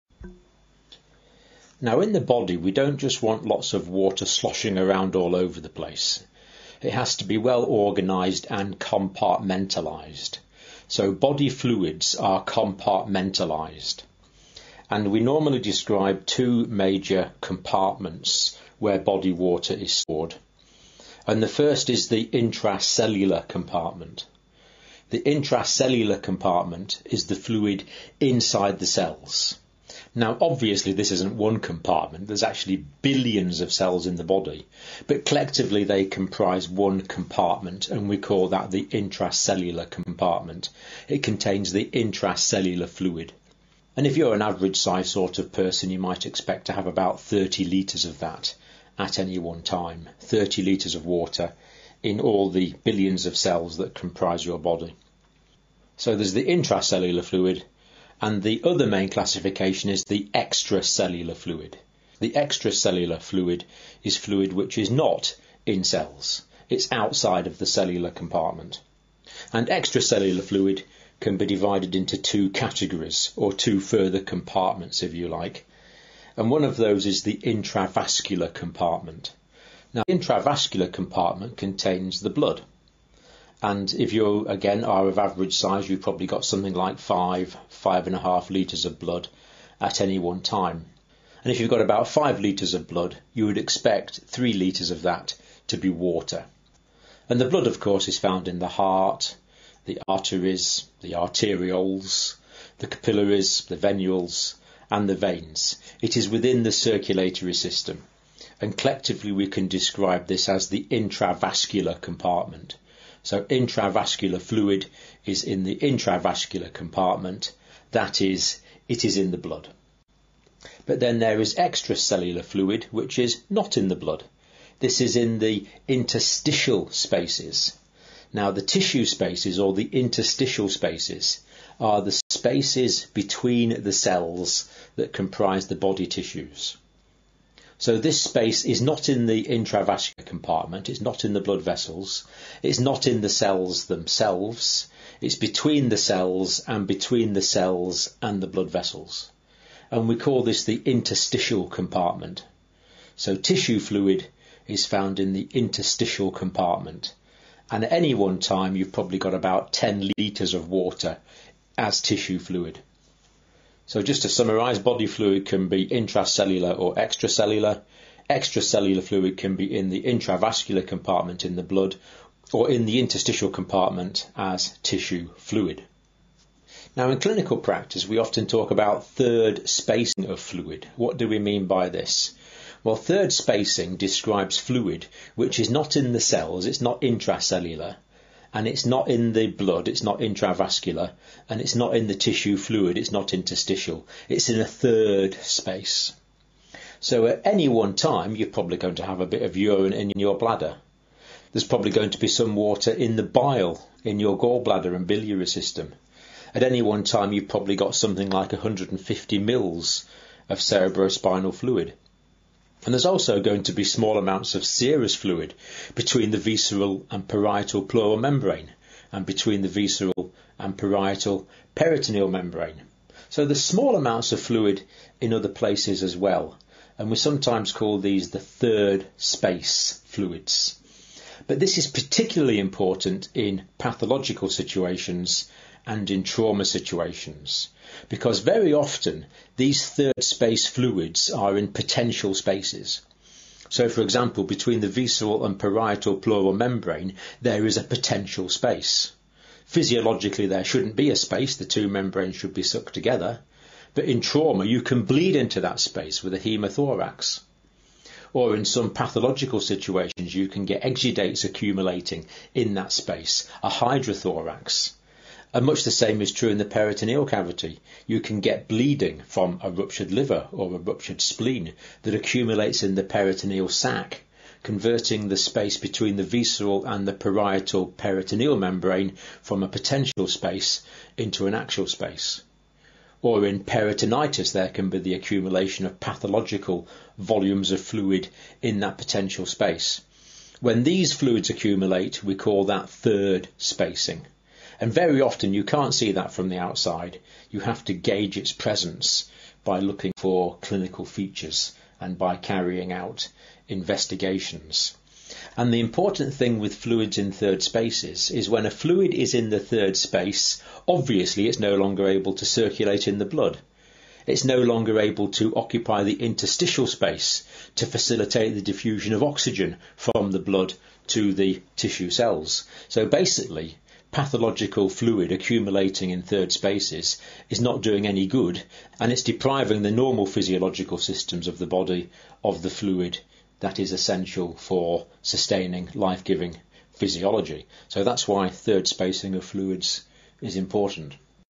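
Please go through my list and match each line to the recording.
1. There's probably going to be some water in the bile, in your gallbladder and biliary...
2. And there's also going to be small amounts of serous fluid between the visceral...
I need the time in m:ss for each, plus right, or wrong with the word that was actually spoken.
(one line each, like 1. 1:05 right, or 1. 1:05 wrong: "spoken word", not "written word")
1. 3:21 right
2. 3:32 right.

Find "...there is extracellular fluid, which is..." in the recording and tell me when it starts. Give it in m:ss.
2:01.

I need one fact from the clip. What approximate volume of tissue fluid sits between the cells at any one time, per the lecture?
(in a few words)
10 litres.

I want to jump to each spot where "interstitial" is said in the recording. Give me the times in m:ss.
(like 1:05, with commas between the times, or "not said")
2:05, 2:09, 2:30, 2:35, 2:52, 3:13, 5:16.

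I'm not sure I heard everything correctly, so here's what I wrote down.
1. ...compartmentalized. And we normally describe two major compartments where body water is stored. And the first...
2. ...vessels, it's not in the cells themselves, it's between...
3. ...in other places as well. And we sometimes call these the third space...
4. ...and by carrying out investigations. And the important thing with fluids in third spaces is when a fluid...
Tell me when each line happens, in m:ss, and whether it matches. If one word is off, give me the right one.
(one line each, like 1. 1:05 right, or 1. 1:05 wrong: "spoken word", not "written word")
1. 0:12 right
2. 2:21 right
3. 3:45 right
4. 5:01 right.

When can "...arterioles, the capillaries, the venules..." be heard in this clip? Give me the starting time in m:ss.
1:41.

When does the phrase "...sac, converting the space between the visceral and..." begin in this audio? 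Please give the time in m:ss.
4:33.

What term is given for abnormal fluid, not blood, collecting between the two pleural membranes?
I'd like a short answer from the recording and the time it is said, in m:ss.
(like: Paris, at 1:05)
hydrothorax, at 4:23.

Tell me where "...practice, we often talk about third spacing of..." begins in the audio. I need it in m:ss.
2:57.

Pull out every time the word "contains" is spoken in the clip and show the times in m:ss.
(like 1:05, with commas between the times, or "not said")
0:41, 1:21.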